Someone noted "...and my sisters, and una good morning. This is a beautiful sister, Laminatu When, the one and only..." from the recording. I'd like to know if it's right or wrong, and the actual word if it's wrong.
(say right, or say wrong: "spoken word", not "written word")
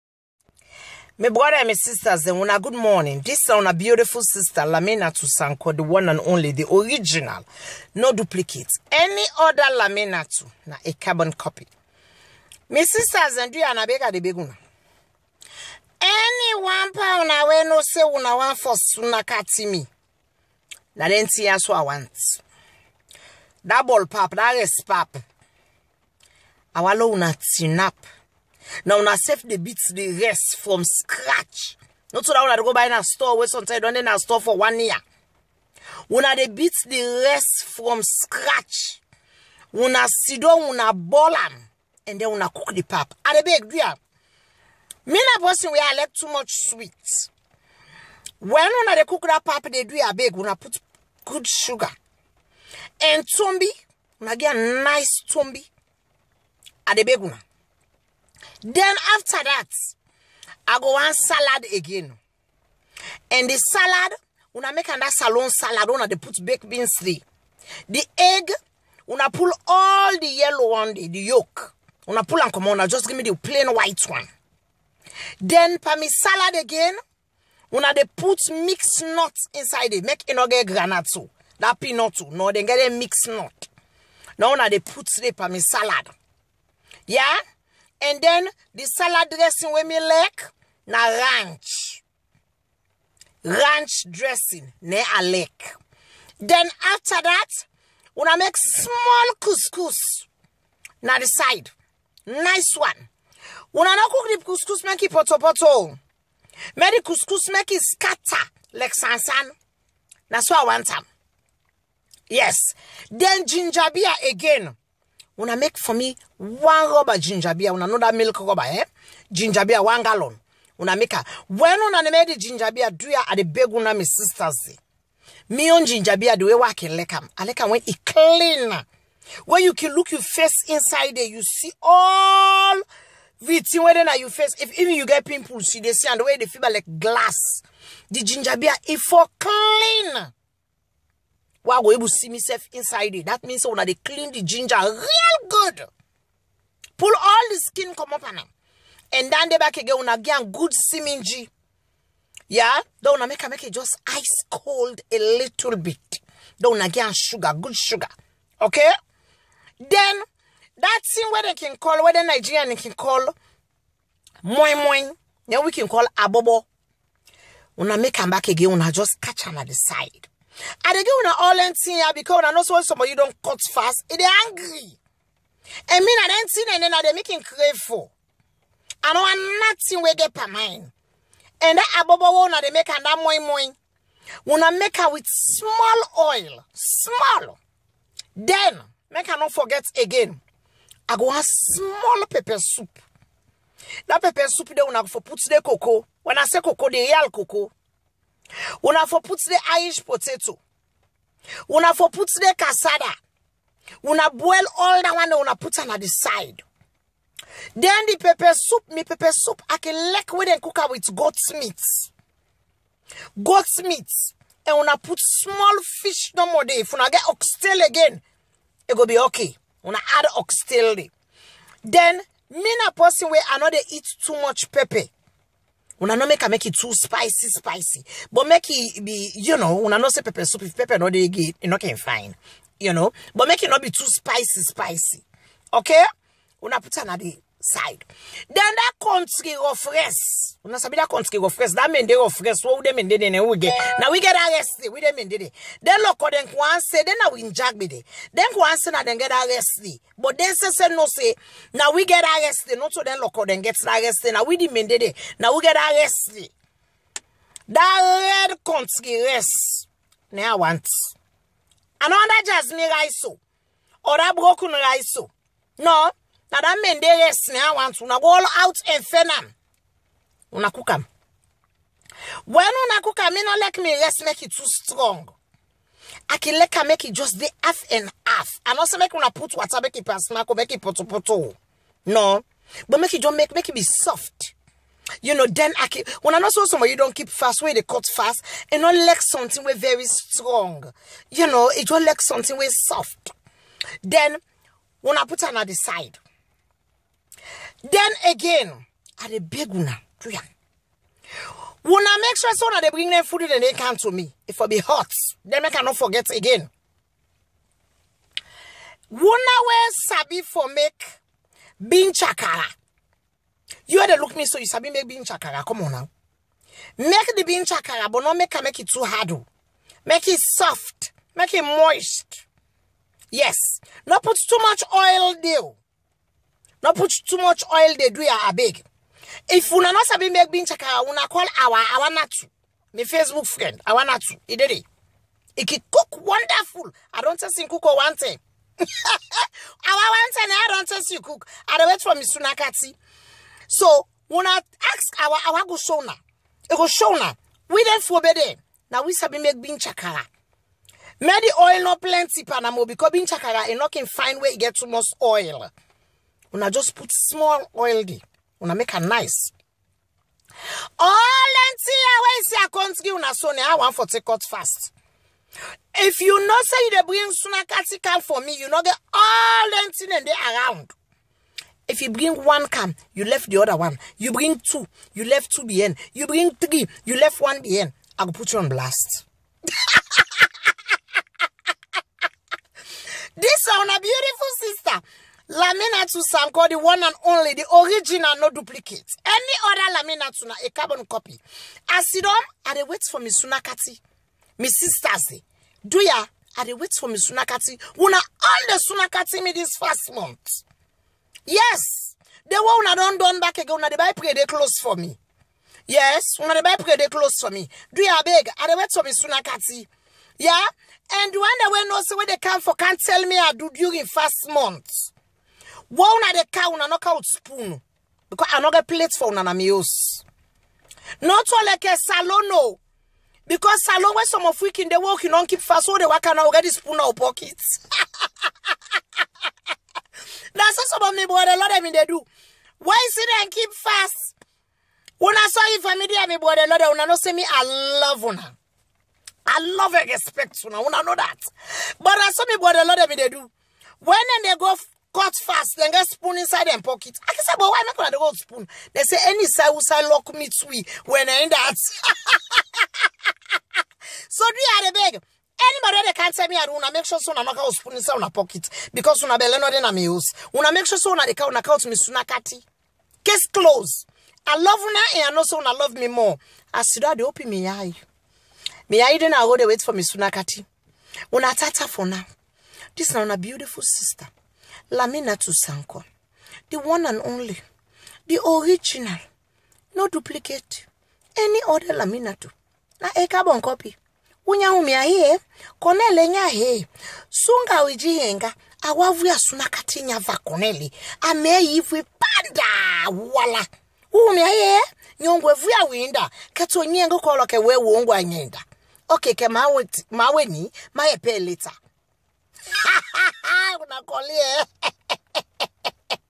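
wrong: "Sanko", not "When".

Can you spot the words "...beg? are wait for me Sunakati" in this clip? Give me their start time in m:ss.
6:48.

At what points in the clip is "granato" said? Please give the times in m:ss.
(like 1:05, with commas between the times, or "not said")
1:20.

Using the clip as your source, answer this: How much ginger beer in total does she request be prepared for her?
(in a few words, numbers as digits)
One gallon.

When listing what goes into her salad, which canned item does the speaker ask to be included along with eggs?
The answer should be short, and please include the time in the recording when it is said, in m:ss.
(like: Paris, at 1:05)
baked beans, at 1:06.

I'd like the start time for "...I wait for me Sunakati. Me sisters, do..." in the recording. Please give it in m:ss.
6:32.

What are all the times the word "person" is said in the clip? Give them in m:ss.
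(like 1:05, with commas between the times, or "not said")
0:45, 3:42.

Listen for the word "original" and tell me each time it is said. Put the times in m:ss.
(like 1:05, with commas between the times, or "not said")
0:06, 6:27, 7:58.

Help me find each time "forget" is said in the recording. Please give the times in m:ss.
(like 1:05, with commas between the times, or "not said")
3:09, 5:05.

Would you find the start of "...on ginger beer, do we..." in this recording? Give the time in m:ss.
2:05.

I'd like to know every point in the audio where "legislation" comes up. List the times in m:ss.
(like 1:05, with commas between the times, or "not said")
not said.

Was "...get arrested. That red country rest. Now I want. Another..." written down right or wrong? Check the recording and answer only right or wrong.
right.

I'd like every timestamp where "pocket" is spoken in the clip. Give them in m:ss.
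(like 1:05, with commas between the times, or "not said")
7:07, 7:26, 7:38.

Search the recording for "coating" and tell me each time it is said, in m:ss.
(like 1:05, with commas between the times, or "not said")
not said.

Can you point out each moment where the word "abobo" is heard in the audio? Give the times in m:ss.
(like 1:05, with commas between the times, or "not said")
2:46, 3:02.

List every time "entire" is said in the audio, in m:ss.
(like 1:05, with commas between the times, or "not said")
6:01, 6:09.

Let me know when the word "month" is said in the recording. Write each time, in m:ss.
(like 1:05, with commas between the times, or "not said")
6:40, 6:54.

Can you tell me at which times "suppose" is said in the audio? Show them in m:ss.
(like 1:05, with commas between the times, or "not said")
not said.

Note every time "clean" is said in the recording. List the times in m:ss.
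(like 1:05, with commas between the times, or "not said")
2:08, 2:19, 2:23.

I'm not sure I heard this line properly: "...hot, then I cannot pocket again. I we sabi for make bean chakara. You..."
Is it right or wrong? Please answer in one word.
wrong.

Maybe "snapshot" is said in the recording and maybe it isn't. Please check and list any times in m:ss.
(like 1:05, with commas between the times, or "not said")
not said.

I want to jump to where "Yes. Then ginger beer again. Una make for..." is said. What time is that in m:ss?
1:52.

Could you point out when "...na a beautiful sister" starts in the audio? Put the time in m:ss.
7:53.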